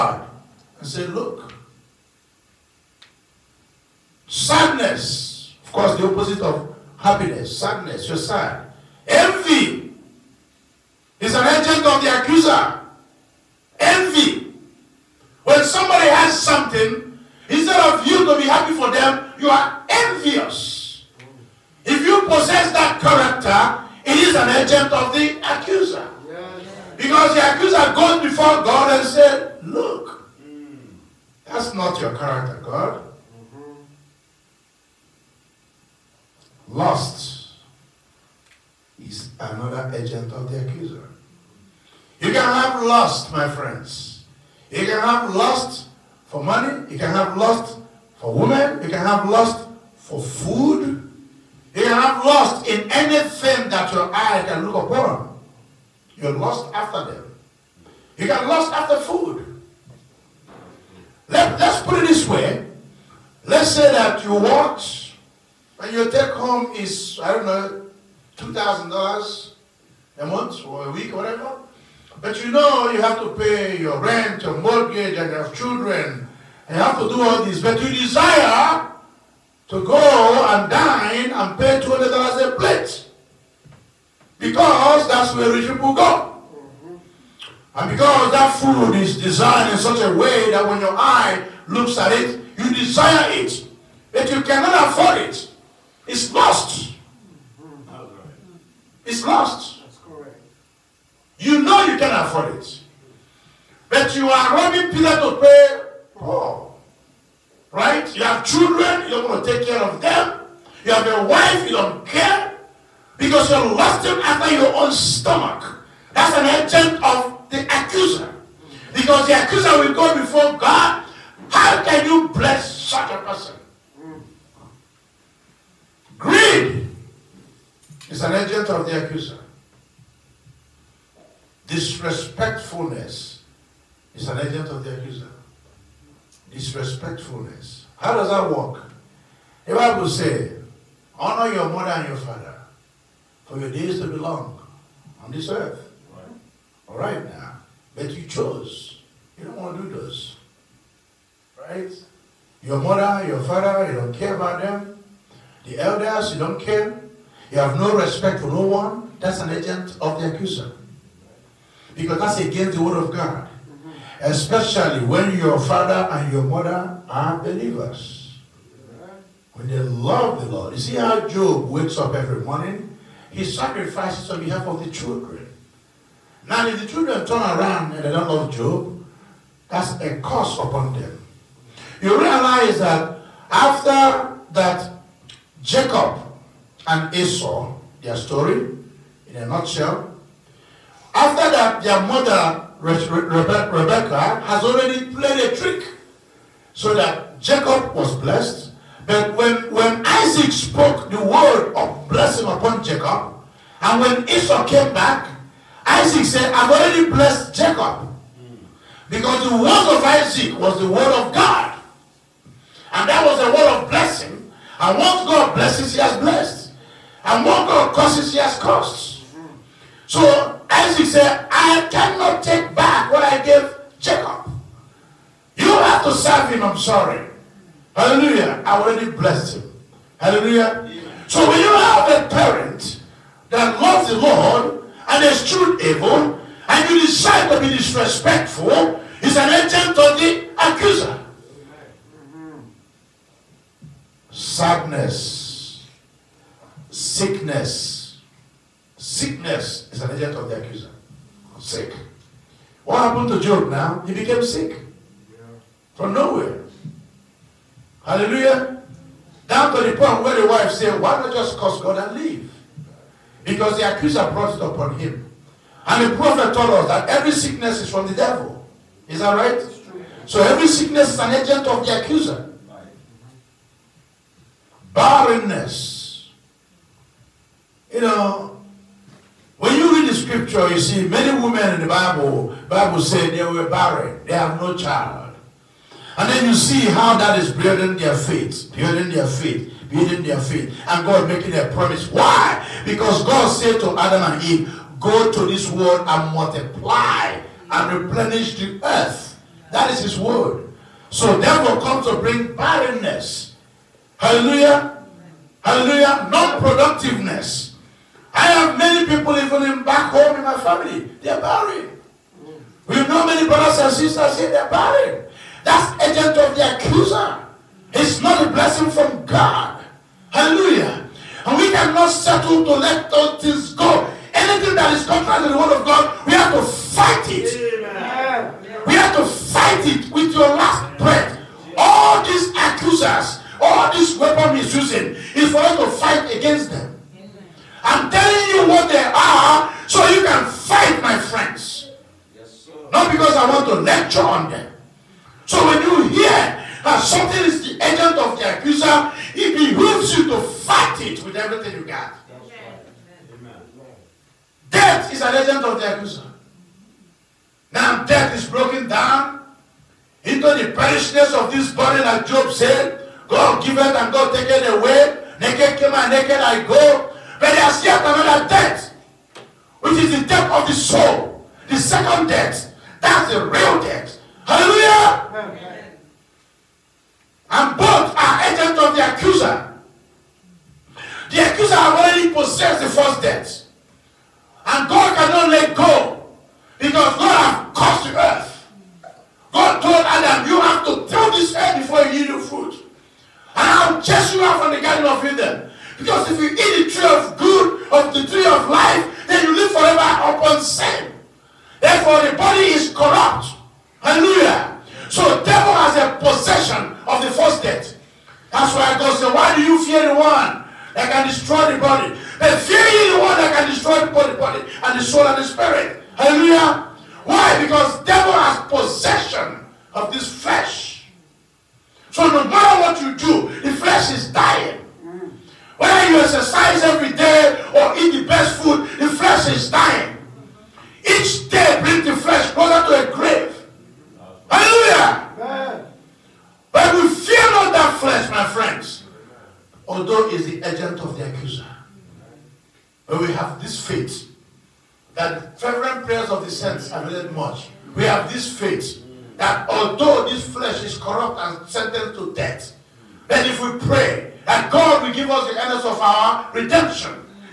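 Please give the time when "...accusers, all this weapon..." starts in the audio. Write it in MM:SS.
05:32.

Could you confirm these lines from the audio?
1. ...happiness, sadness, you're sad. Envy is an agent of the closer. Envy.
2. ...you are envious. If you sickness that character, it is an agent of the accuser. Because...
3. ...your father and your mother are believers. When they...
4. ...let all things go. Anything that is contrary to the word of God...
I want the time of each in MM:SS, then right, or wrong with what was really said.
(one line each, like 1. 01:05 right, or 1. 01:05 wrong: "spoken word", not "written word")
1. 00:06 wrong: "accuser", not "closer"
2. 00:19 wrong: "possess", not "sickness"
3. 02:45 right
4. 05:22 right.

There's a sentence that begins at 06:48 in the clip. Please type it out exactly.
That's why God said, why do you fear the one that can destroy the body?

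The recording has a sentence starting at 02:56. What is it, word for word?
Now, if the children turn around and they don't love Job, that's a curse upon them.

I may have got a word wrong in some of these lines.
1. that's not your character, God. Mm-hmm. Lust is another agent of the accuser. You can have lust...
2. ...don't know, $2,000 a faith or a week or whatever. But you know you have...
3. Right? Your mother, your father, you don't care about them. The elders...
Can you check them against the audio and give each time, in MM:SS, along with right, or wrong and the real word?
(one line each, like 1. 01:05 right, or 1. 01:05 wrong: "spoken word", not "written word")
1. 00:31 right
2. 01:07 wrong: "month", not "faith"
3. 02:31 right.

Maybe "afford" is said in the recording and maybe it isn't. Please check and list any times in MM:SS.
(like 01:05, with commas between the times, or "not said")
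01:34, 01:42.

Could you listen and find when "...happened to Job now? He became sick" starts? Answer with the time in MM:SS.
04:12.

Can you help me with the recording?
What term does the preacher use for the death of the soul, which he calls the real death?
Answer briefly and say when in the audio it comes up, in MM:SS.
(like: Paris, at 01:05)
The second death, at 06:11.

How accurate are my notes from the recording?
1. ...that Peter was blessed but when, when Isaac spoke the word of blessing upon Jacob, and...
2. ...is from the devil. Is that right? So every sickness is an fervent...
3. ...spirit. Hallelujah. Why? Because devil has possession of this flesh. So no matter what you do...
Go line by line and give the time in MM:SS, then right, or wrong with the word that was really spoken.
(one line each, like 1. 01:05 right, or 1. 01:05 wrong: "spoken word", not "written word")
1. 03:16 wrong: "Jacob", not "Peter"
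2. 04:27 wrong: "agent", not "fervent"
3. 06:55 right.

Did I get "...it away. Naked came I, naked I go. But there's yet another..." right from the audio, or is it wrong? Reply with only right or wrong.
right.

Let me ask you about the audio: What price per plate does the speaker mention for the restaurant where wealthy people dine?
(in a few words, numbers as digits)
$200.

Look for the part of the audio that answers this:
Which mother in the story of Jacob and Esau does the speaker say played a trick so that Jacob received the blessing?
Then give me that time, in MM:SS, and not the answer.
03:13.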